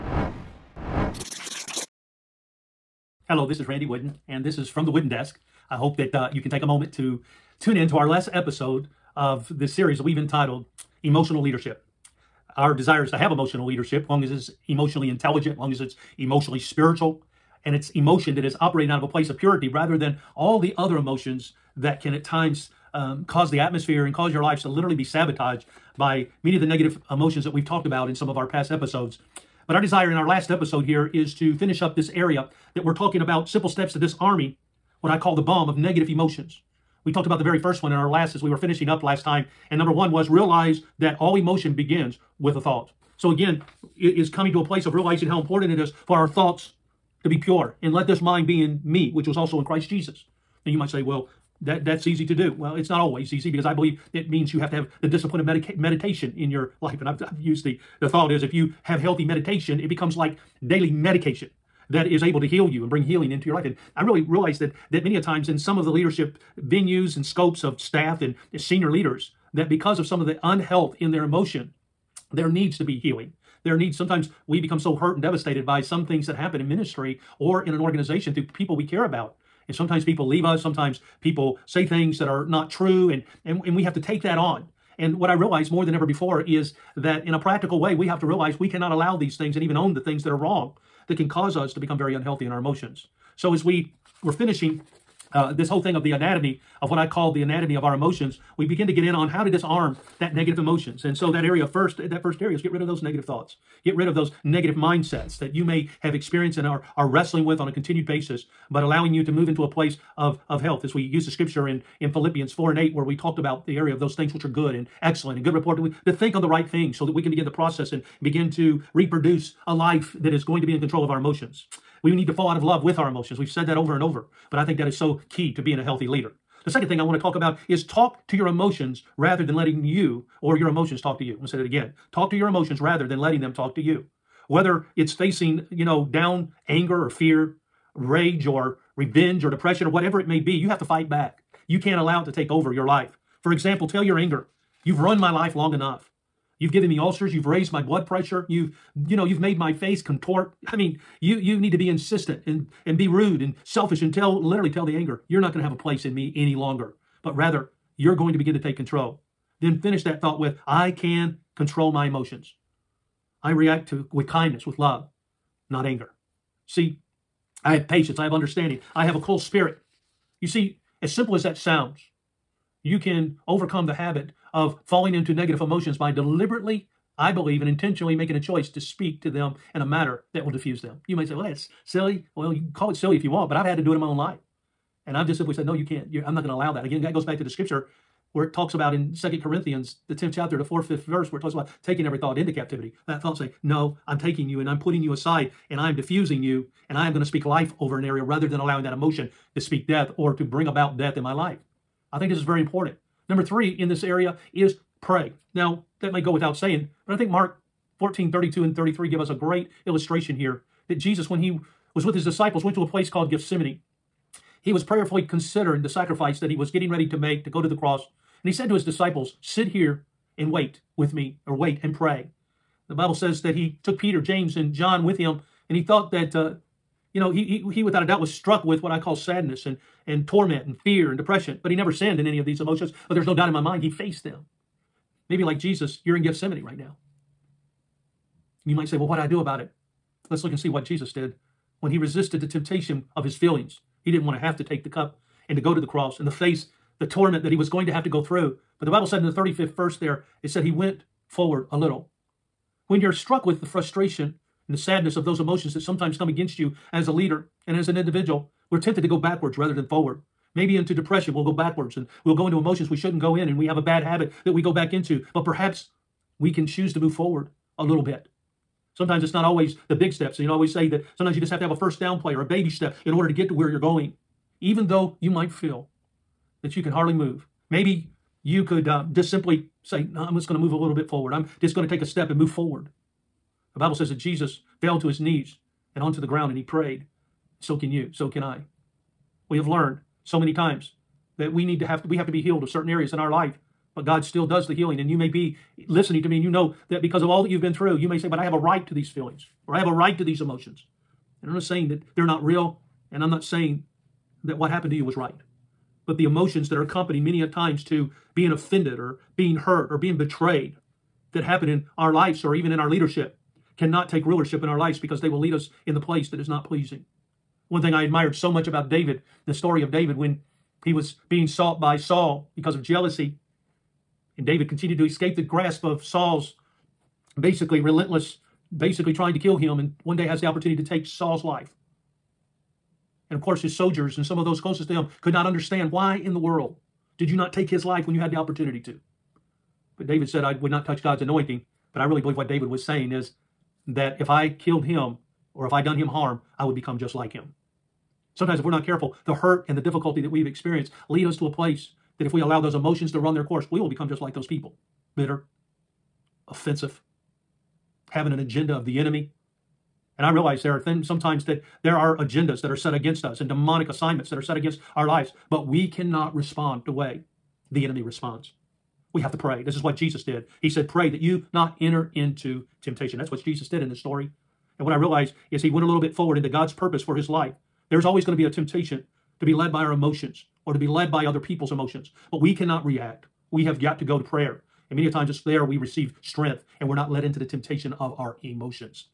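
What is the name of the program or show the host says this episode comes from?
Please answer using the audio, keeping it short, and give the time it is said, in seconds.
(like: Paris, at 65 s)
The Wooden Desk, at 4 s.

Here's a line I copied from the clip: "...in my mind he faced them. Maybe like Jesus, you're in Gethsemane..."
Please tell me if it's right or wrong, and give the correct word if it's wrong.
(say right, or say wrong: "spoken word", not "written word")
right.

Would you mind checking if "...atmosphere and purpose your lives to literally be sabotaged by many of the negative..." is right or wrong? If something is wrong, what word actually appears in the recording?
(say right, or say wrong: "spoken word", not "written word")
wrong: "cause", not "purpose".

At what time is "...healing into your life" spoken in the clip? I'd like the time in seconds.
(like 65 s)
63 s.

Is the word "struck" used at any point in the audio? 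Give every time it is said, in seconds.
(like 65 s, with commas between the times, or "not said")
228 s, 253 s.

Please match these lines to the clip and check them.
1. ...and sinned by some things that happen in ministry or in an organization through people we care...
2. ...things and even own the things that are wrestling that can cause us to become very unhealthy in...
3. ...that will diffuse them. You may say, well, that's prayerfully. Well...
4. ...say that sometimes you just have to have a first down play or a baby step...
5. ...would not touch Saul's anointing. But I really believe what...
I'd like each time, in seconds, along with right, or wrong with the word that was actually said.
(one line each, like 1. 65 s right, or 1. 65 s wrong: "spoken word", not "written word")
1. 75 s wrong: "devastated", not "sinned"
2. 89 s wrong: "wrong", not "wrestling"
3. 180 s wrong: "silly", not "prayerfully"
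4. 270 s right
5. 340 s wrong: "God", not "Saul".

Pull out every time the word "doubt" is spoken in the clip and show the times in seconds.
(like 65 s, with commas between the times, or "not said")
228 s, 233 s.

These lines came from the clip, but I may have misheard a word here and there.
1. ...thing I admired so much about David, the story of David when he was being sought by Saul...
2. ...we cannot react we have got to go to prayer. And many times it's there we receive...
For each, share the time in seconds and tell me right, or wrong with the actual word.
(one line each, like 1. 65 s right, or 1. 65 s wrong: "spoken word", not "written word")
1. 317 s right
2. 382 s right.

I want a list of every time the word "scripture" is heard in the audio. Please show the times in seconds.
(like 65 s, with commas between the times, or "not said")
111 s, 187 s.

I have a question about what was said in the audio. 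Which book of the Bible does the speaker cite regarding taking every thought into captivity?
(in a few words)
Second Corinthians.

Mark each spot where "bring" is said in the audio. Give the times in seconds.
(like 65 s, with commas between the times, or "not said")
62 s, 200 s.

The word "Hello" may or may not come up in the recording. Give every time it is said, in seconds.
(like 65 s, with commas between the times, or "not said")
3 s.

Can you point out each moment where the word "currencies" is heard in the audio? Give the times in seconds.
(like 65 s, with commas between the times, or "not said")
not said.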